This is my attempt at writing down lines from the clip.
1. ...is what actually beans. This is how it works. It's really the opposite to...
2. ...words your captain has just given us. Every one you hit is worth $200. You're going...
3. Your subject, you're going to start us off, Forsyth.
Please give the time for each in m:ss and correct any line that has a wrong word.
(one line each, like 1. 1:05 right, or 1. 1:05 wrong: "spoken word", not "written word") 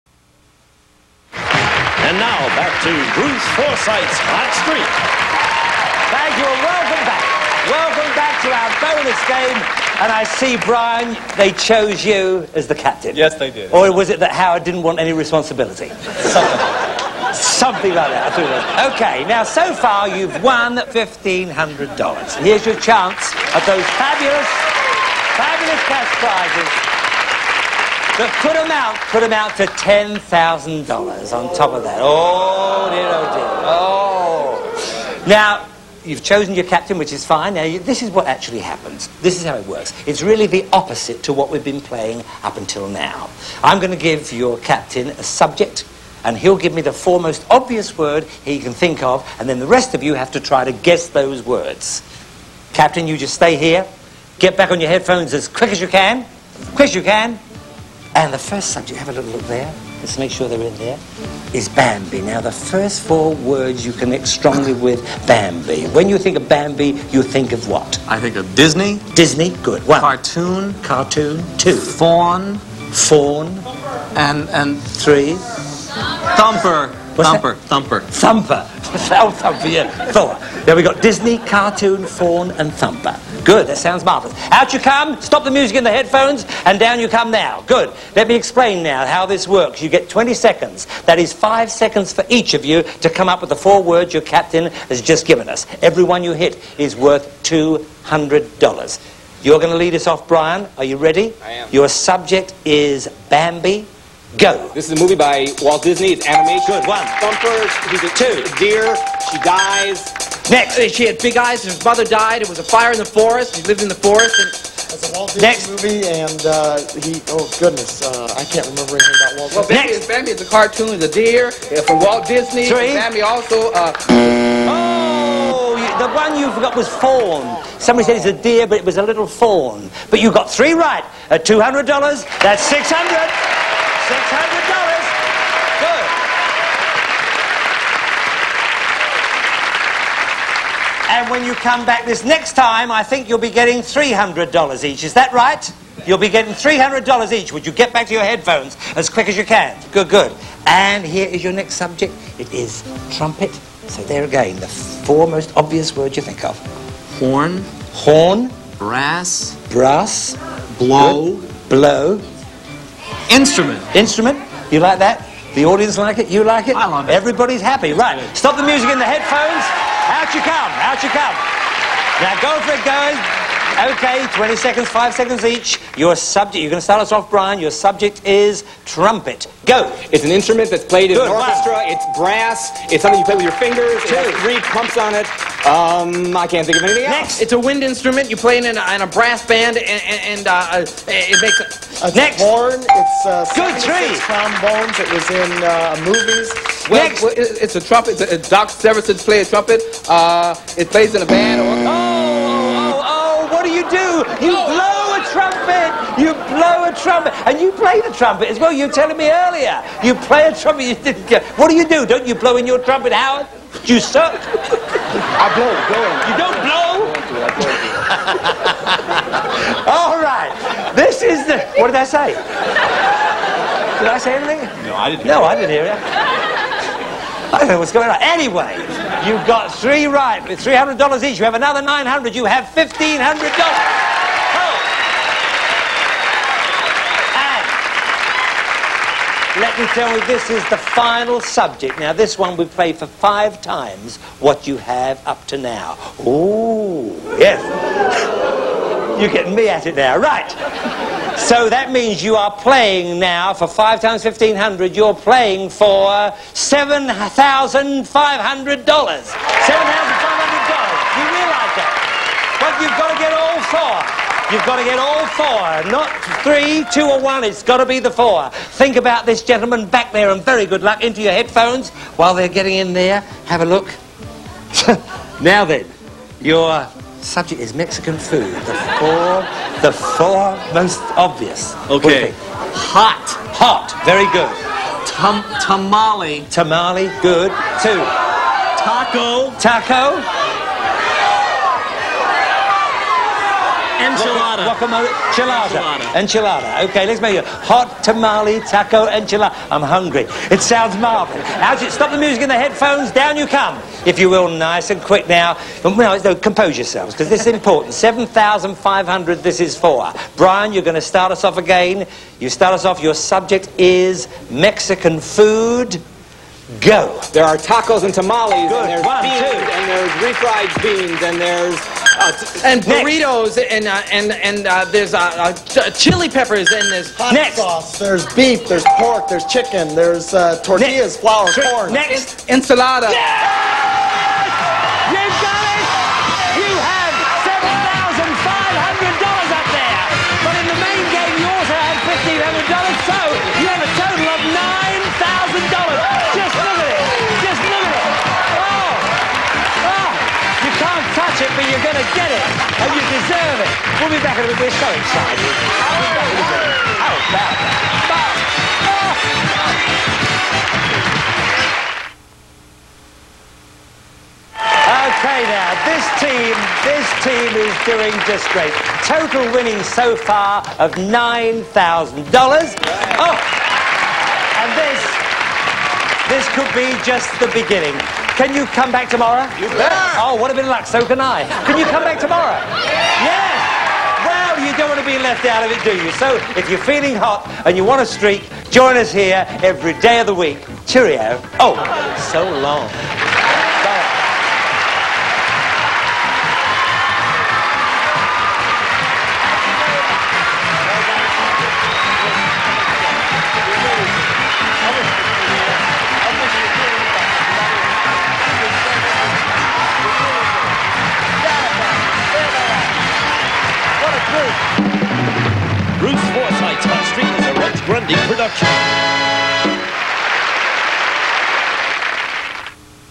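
1. 0:38 wrong: "happens", not "beans"
2. 1:33 right
3. 2:55 wrong: "Brian", not "Forsyth".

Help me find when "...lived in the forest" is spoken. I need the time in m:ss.
1:53.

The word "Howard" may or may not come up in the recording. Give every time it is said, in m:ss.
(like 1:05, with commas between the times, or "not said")
0:14, 3:33.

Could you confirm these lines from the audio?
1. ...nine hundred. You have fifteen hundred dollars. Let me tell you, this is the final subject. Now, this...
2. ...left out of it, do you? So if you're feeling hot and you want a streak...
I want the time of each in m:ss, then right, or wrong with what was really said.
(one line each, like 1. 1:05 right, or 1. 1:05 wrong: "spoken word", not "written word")
1. 3:51 right
2. 6:25 right.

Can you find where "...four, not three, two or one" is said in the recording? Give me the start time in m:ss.
4:25.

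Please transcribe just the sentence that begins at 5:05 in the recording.
Now, no, compose yourselves, because this is important.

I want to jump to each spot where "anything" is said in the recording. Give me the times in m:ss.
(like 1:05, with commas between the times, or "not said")
1:58, 3:06, 3:44.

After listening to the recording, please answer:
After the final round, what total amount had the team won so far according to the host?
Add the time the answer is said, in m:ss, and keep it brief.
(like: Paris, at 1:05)
$9,000, at 6:10.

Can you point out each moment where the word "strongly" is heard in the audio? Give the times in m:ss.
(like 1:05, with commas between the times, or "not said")
1:04.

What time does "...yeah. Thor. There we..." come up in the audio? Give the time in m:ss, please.
1:19.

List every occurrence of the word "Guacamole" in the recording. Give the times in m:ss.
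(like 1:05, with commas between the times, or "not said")
4:54.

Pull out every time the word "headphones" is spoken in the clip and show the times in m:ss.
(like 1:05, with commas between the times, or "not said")
0:54, 1:25, 2:28, 2:49, 4:31, 5:02.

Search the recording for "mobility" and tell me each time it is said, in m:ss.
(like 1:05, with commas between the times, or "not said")
not said.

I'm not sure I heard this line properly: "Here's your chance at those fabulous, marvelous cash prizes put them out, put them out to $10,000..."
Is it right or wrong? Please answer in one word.
wrong.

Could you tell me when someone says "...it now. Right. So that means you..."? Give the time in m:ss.
4:09.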